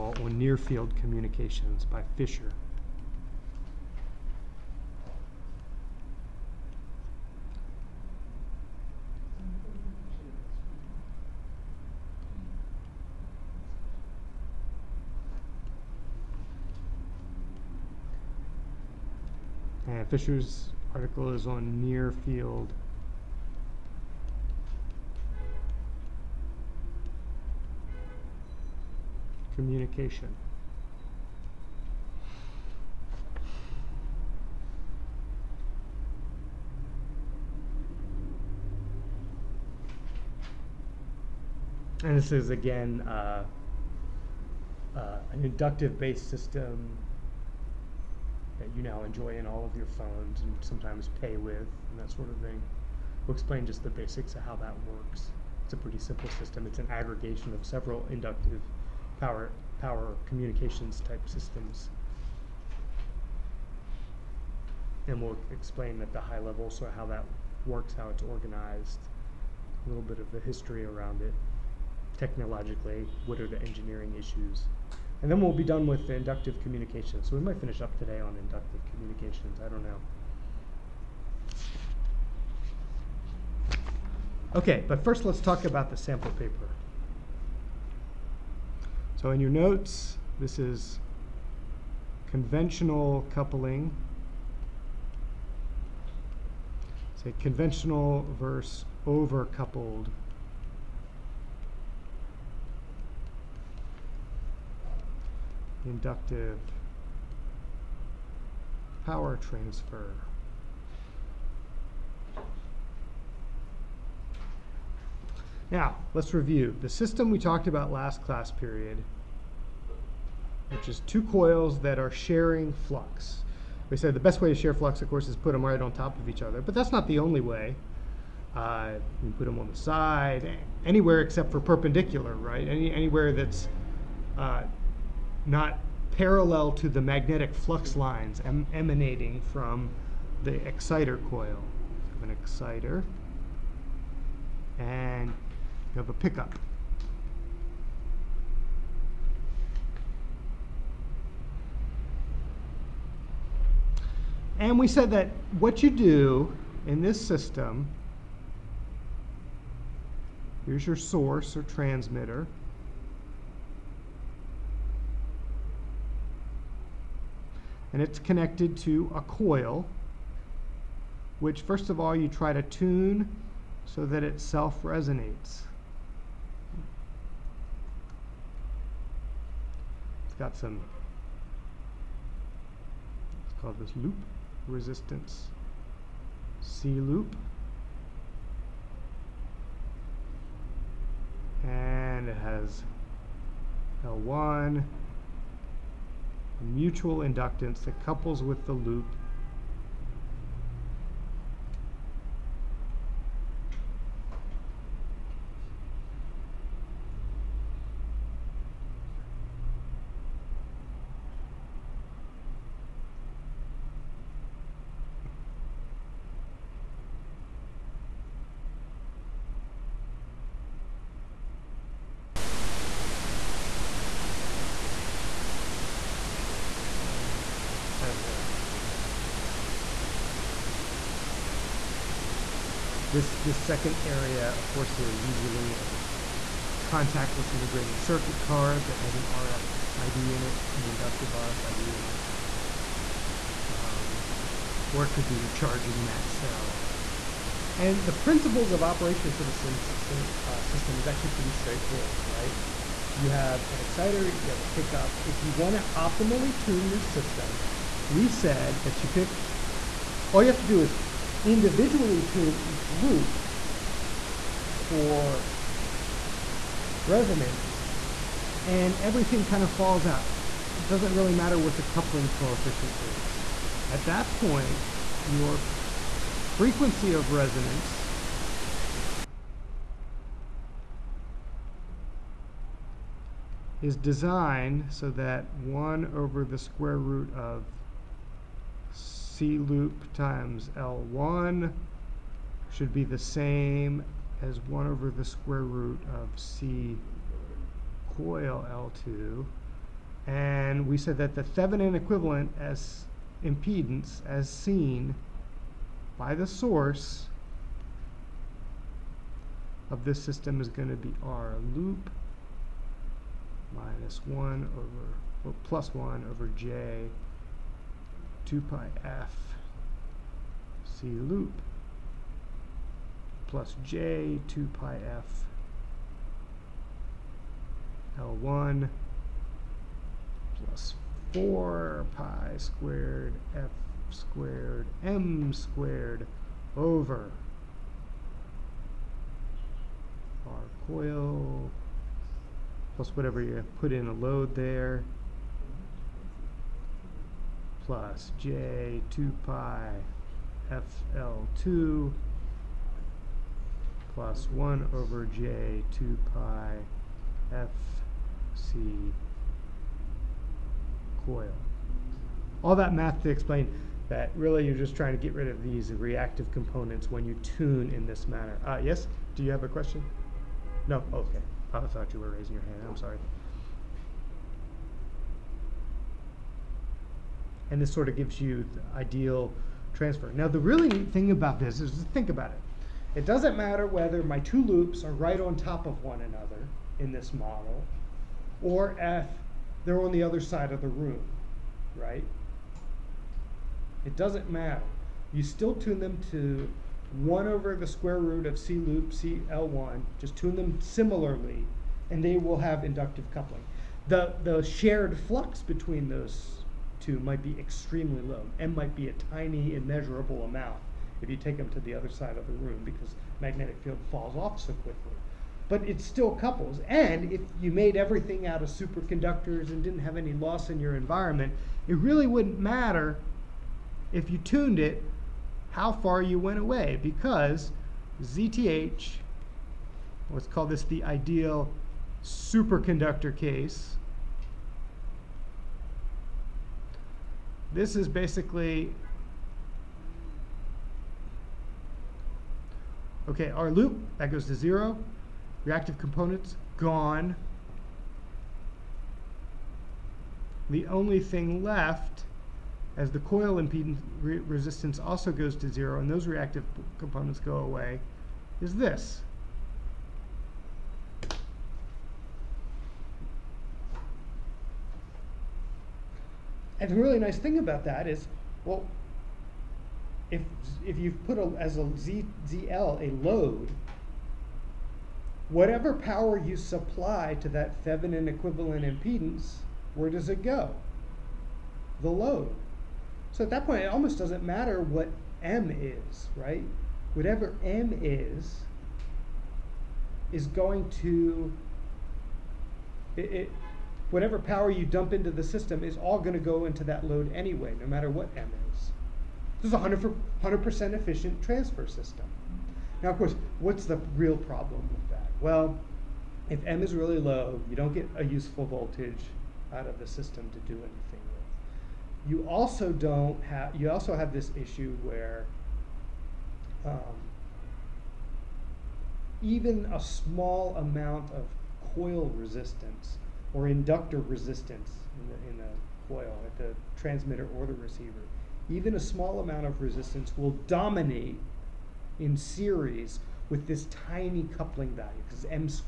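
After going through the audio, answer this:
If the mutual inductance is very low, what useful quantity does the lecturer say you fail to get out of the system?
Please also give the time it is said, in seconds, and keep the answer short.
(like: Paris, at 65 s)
voltage, at 508 s.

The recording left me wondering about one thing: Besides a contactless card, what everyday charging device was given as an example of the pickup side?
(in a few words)
charging mat.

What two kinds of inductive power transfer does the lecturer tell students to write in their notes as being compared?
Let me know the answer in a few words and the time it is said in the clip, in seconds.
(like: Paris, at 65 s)
Conventional versus overcoupled, at 97 s.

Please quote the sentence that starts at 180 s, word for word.
It's got some, it's called this loop resistance, C loop.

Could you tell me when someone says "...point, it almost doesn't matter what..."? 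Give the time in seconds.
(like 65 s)
483 s.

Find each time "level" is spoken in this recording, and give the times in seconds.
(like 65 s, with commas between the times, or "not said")
66 s.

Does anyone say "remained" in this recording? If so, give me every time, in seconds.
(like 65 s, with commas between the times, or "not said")
not said.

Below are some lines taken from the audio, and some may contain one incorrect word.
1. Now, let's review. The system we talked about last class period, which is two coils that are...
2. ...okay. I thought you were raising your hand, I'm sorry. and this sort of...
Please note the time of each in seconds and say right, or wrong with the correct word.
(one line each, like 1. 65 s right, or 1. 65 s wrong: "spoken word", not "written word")
1. 115 s right
2. 371 s right.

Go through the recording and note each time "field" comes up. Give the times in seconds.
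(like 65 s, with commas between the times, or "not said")
0 s, 22 s, 413 s.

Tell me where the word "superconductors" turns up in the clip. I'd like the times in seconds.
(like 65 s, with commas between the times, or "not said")
418 s, 432 s.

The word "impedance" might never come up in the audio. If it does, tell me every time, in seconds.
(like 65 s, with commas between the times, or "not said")
303 s, 453 s, 478 s.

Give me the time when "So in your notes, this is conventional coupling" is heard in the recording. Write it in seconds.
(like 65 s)
89 s.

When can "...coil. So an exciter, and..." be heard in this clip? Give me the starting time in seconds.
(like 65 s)
141 s.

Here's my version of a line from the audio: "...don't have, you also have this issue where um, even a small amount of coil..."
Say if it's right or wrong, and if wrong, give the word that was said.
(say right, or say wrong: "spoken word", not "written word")
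right.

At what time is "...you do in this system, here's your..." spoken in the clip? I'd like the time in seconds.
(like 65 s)
155 s.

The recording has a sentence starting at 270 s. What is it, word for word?
It doesn't really matter what the coupling coefficient is.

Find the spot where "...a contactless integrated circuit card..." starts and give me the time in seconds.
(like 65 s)
235 s.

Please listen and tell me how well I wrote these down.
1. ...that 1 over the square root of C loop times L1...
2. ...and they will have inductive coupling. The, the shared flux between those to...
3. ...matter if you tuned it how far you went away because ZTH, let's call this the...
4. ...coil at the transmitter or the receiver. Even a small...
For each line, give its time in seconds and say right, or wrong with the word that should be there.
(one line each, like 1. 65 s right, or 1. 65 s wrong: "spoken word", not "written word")
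1. 285 s right
2. 402 s right
3. 422 s right
4. 526 s right.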